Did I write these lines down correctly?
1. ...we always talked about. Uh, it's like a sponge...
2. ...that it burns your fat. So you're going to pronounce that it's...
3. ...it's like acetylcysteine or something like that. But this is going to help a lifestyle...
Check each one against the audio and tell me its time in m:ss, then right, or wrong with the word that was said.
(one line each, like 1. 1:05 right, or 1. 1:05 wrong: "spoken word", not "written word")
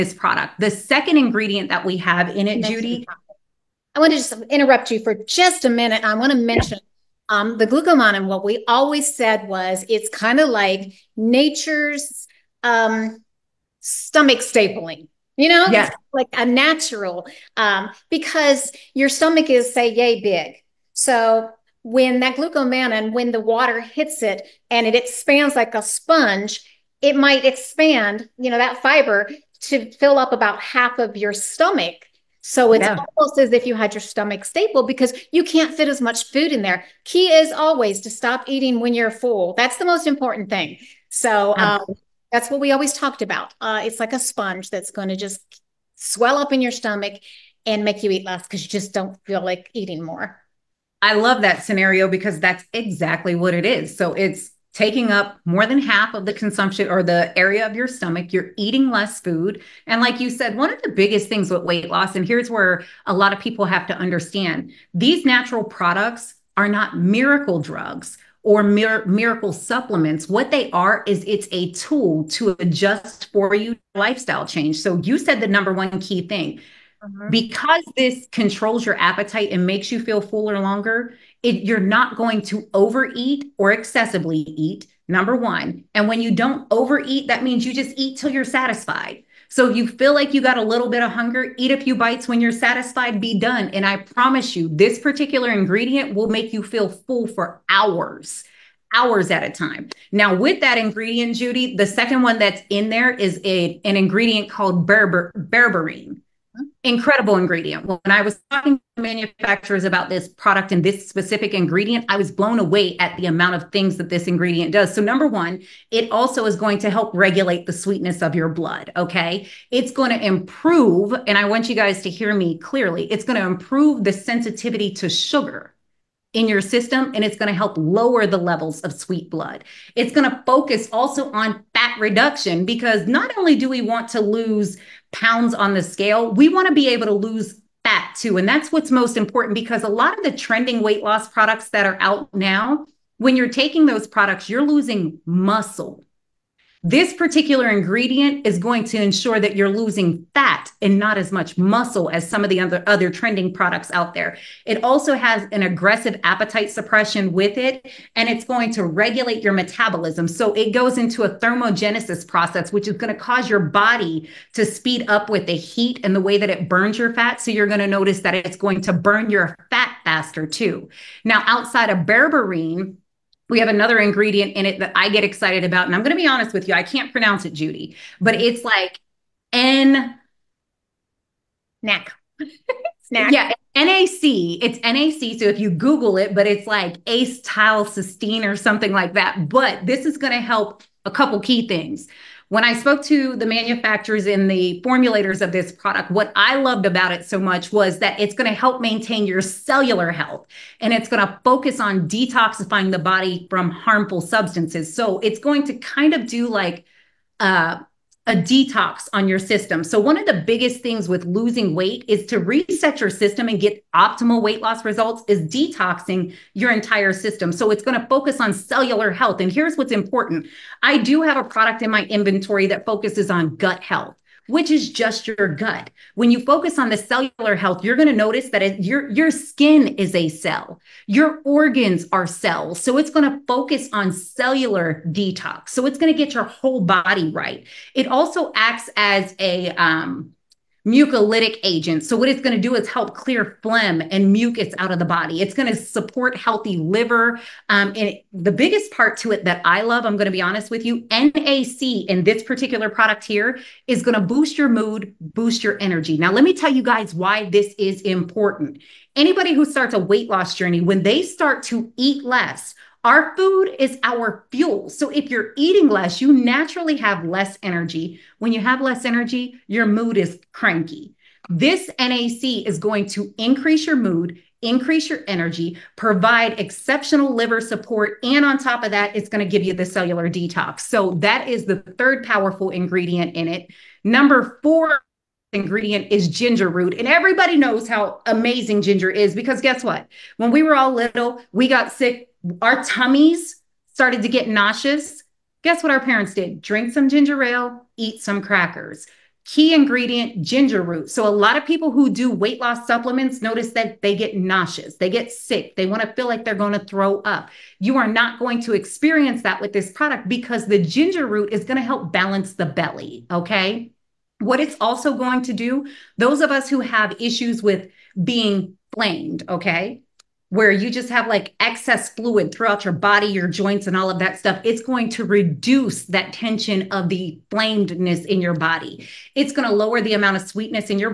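1. 0:42 right
2. 2:46 wrong: "notice", not "pronounce"
3. 3:06 wrong: "couple", not "lifestyle".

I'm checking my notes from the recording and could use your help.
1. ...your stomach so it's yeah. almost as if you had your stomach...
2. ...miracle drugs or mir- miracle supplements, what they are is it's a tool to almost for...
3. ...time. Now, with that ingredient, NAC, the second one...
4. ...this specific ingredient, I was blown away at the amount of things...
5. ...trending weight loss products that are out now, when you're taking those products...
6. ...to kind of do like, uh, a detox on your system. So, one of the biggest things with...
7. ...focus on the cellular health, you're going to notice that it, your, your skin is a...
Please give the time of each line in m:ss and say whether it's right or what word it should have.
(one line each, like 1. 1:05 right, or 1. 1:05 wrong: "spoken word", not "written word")
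1. 0:31 right
2. 1:06 wrong: "adjust", not "almost"
3. 1:39 wrong: "Judy", not "NAC"
4. 1:50 right
5. 2:20 right
6. 3:25 right
7. 3:46 right.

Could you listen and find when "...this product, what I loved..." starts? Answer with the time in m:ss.
3:15.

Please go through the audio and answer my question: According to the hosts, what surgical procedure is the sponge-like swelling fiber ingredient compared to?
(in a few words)
stomach stapling.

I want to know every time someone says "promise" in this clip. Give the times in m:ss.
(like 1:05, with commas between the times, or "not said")
1:33.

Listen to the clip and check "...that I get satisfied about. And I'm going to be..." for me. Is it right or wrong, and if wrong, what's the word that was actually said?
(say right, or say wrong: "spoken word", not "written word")
wrong: "excited", not "satisfied".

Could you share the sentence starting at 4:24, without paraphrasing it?
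So if you're eating less, you naturally have less energy.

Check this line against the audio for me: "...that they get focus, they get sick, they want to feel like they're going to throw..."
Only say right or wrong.
wrong.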